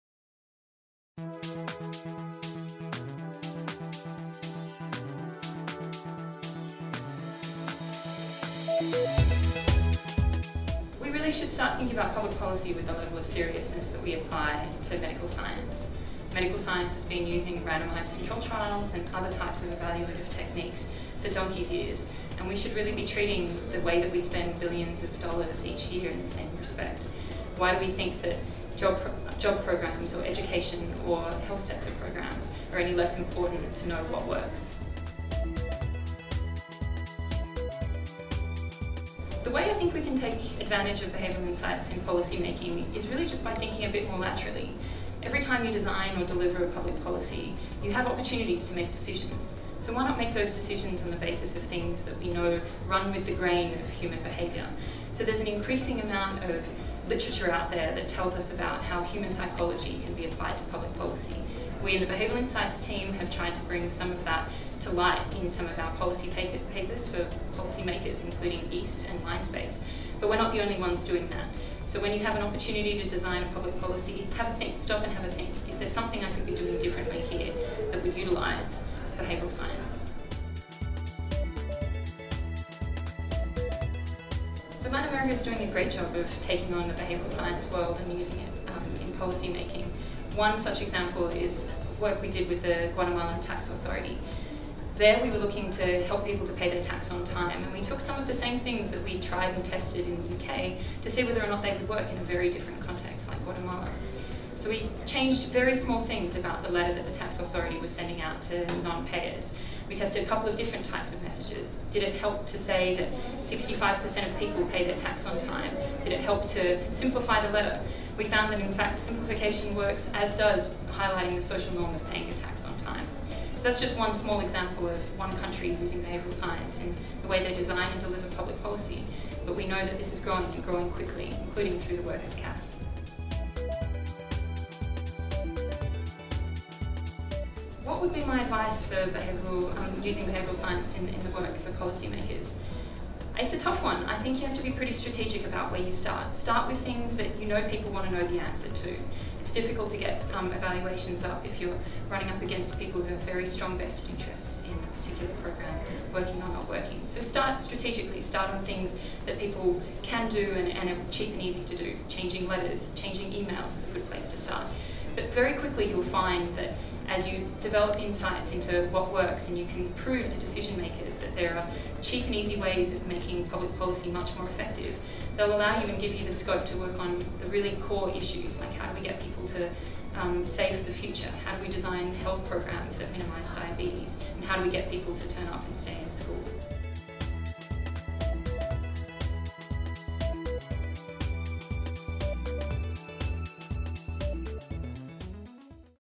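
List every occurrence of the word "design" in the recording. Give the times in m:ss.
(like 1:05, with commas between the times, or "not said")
0:45, 1:13, 2:07, 3:01.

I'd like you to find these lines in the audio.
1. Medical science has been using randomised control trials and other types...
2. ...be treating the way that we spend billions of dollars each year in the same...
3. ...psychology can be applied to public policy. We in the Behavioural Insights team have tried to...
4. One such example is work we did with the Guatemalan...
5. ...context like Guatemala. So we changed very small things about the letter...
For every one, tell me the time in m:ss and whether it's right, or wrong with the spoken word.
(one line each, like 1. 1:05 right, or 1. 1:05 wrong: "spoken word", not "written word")
1. 0:16 right
2. 0:22 right
3. 0:59 right
4. 1:30 right
5. 1:42 right.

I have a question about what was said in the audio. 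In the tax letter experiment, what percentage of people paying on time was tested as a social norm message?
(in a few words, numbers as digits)
65%.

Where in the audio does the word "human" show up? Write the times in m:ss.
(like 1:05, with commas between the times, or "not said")
0:53, 0:59.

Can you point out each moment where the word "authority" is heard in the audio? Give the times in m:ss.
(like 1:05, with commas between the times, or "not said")
1:33, 1:47.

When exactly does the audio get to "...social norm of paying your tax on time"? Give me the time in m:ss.
2:01.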